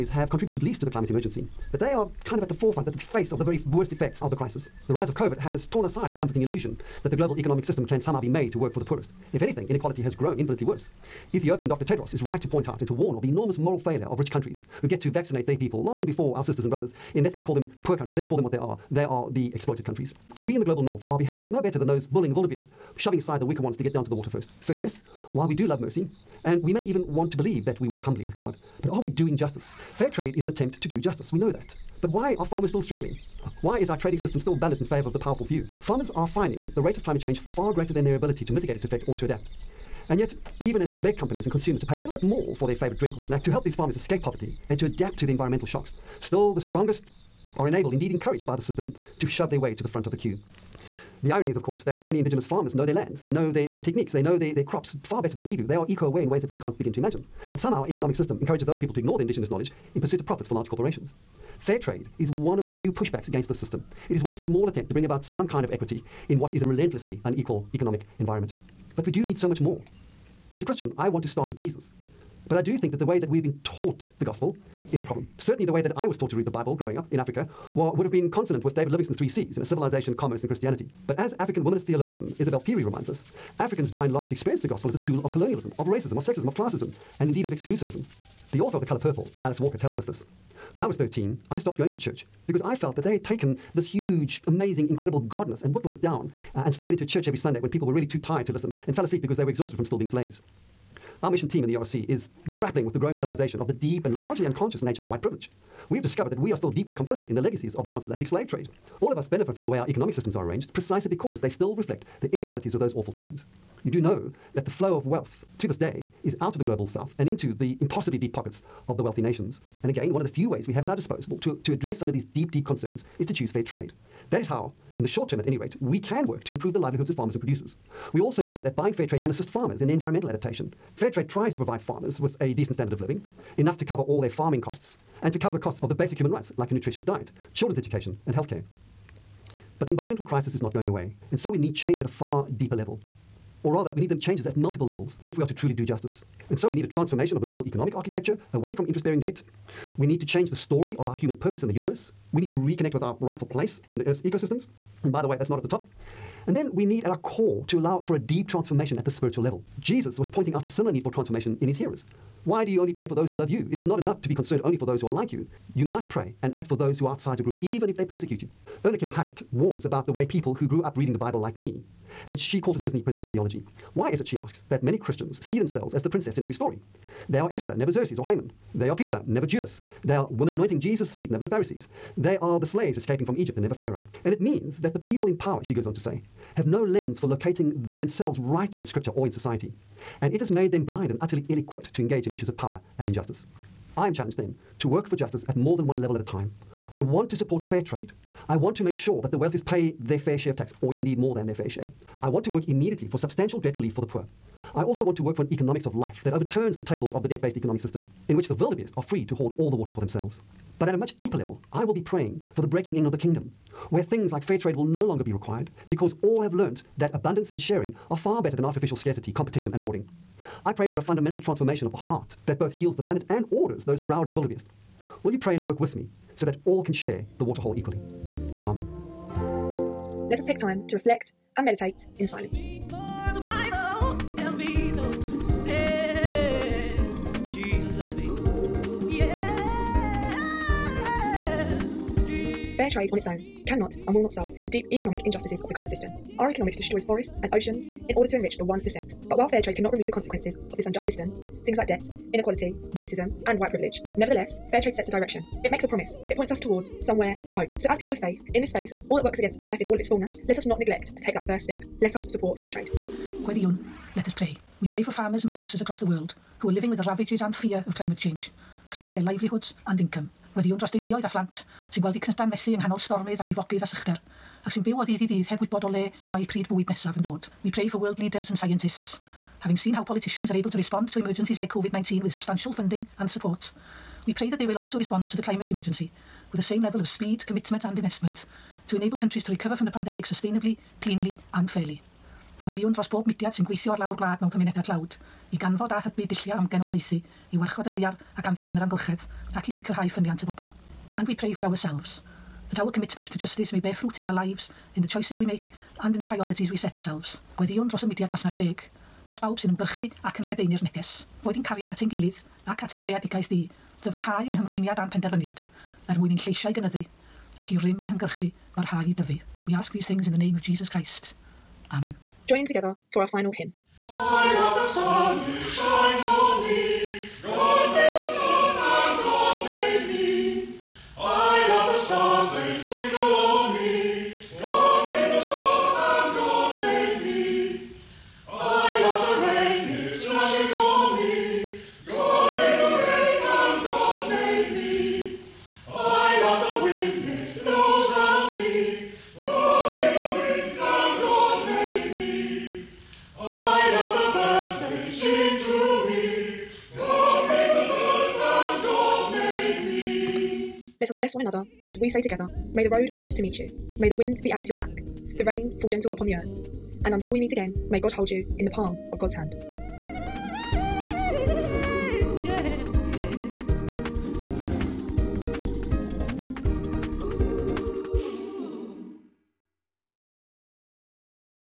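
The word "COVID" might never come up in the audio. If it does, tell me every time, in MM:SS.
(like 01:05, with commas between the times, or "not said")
00:05, 04:41.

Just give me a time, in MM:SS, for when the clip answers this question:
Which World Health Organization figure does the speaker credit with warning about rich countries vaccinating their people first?
00:11.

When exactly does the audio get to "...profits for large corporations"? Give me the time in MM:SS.
01:00.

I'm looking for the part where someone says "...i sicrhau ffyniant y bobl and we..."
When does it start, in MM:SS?
04:59.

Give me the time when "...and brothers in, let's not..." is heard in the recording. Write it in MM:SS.
00:16.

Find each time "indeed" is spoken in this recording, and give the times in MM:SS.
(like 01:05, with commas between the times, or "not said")
00:47, 01:27, 03:20.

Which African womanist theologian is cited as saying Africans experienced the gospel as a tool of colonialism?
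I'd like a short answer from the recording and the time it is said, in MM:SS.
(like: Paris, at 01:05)
Isabel Phiri, at 01:22.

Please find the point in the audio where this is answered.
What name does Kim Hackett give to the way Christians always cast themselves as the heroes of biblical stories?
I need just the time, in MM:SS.
02:52.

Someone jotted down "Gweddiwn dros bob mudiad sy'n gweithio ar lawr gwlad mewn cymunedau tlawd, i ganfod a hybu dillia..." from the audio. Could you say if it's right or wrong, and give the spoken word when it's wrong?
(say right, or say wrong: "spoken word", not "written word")
right.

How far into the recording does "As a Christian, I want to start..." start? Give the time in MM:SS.
01:10.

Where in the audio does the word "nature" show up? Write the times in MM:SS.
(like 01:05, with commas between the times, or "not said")
01:44.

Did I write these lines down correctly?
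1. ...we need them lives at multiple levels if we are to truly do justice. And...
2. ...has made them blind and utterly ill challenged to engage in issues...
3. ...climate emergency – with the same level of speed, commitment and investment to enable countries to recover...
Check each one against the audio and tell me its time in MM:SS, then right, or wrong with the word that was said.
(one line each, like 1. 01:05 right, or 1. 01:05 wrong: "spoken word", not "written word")
1. 02:23 wrong: "changes", not "lives"
2. 03:10 wrong: "equipped", not "challenged"
3. 04:45 right.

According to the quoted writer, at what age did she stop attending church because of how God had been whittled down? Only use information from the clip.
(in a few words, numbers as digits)
13.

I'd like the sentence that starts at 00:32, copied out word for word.
But why are farmers still struggling?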